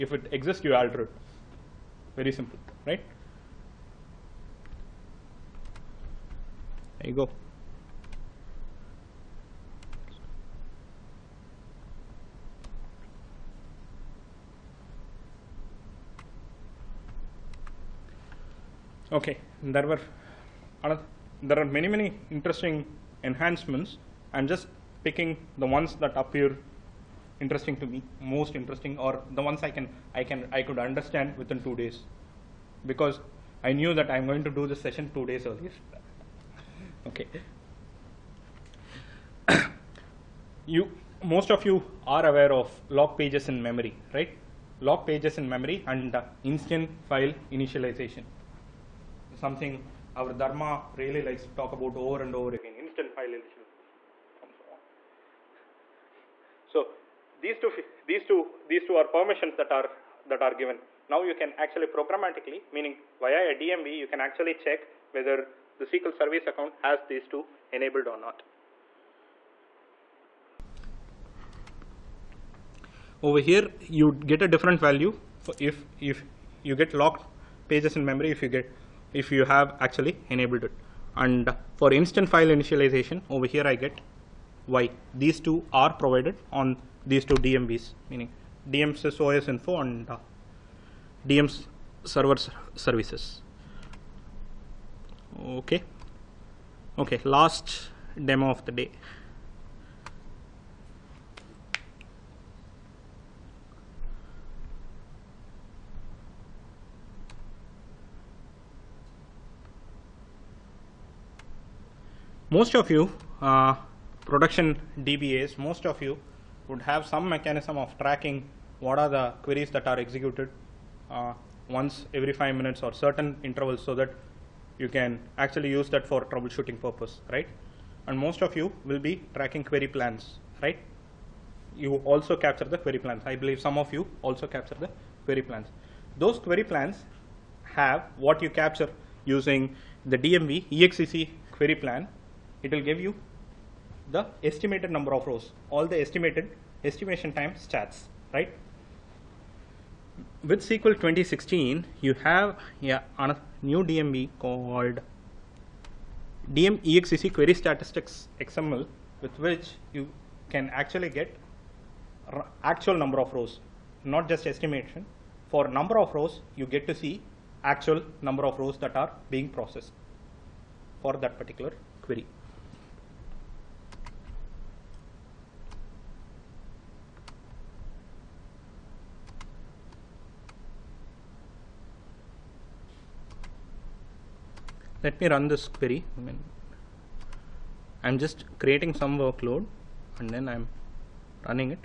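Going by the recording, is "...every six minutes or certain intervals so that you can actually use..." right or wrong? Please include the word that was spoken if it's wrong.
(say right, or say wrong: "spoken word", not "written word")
wrong: "five", not "six".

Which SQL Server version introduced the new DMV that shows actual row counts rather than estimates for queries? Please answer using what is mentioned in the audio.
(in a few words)
SQL 2016.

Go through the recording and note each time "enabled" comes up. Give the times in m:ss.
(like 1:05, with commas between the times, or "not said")
1:07, 1:20.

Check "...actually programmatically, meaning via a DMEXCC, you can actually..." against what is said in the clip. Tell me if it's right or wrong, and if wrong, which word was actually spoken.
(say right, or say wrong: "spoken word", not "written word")
wrong: "DMV", not "DMEXCC".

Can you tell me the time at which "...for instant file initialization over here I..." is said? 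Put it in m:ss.
1:21.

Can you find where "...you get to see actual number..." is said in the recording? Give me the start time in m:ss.
2:46.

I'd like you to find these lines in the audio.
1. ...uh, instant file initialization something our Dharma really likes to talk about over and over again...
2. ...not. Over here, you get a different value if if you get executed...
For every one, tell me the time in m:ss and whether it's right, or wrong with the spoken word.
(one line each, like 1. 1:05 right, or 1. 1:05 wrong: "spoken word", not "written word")
1. 0:46 right
2. 1:08 wrong: "locked", not "executed".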